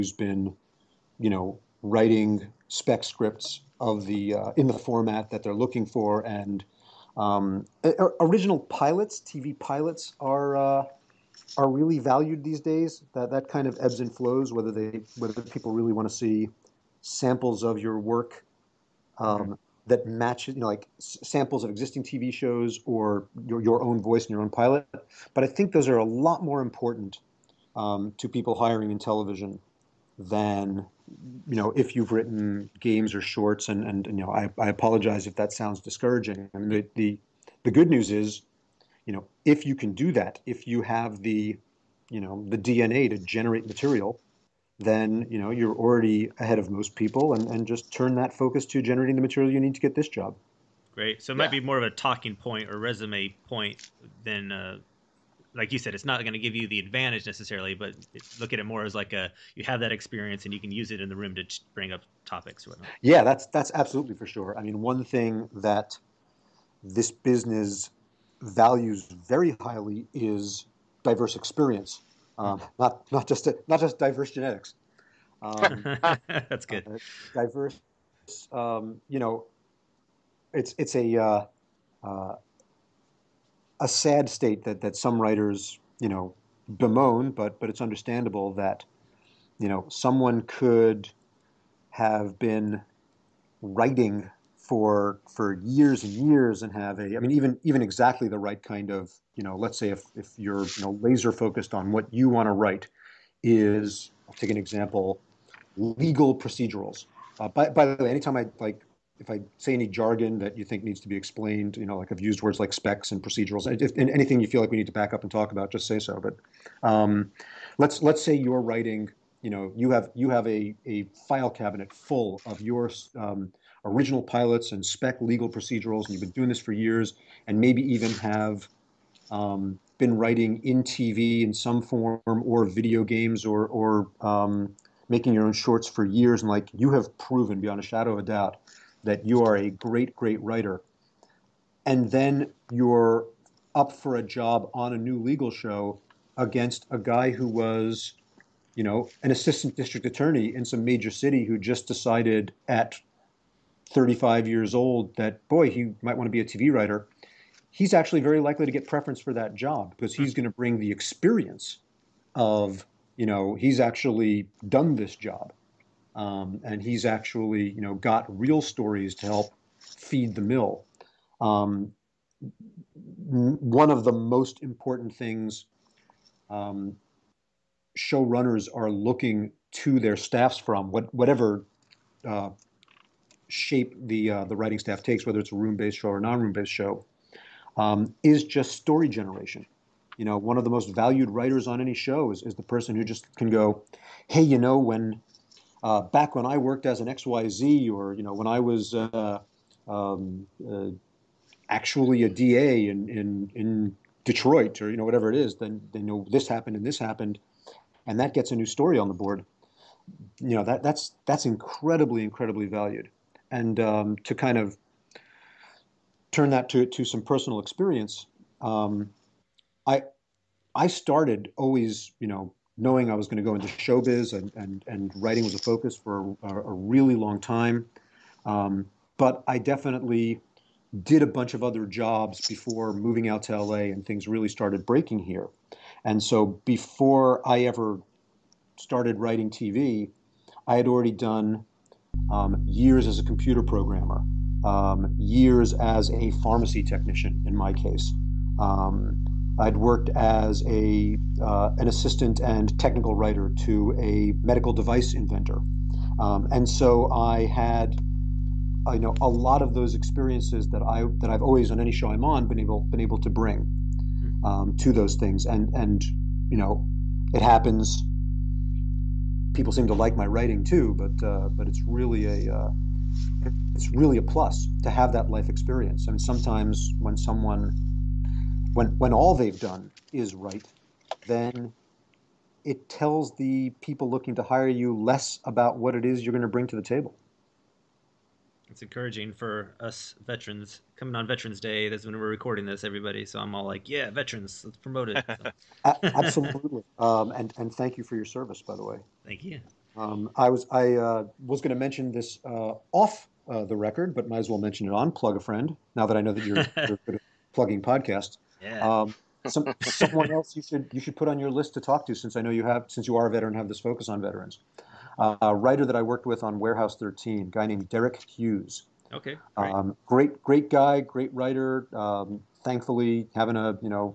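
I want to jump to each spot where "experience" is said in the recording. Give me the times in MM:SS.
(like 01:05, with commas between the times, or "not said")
00:59, 01:11, 02:40, 03:37, 04:19, 04:35.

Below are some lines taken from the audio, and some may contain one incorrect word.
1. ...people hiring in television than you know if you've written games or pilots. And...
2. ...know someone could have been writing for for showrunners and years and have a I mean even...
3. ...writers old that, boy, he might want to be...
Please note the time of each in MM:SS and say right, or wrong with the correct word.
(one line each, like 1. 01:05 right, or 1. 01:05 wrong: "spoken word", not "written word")
1. 00:28 wrong: "shorts", not "pilots"
2. 01:29 wrong: "years", not "showrunners"
3. 02:34 wrong: "years", not "writers".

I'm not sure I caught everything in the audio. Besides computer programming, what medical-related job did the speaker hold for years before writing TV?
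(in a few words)
Pharmacy technician.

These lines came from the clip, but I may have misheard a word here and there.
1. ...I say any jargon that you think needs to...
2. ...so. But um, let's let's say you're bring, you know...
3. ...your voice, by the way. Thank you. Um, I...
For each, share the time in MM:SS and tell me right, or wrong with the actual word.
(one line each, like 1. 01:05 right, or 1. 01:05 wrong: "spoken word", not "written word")
1. 01:49 right
2. 01:55 wrong: "writing", not "bring"
3. 04:58 wrong: "service", not "voice".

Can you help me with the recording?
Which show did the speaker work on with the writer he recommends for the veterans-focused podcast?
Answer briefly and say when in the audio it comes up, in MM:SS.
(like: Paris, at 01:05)
Warehouse 13, at 05:16.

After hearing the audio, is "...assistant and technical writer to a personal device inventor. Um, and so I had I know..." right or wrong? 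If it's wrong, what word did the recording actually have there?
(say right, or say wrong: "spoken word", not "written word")
wrong: "medical", not "personal".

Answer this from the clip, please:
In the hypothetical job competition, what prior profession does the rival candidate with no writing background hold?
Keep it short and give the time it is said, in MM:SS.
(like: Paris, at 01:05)
Assistant district attorney, at 02:29.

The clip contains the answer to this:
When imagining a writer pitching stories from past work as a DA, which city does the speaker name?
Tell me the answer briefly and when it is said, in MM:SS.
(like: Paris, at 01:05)
Detroit, at 03:24.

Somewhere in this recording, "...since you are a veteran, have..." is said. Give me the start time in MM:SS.
05:12.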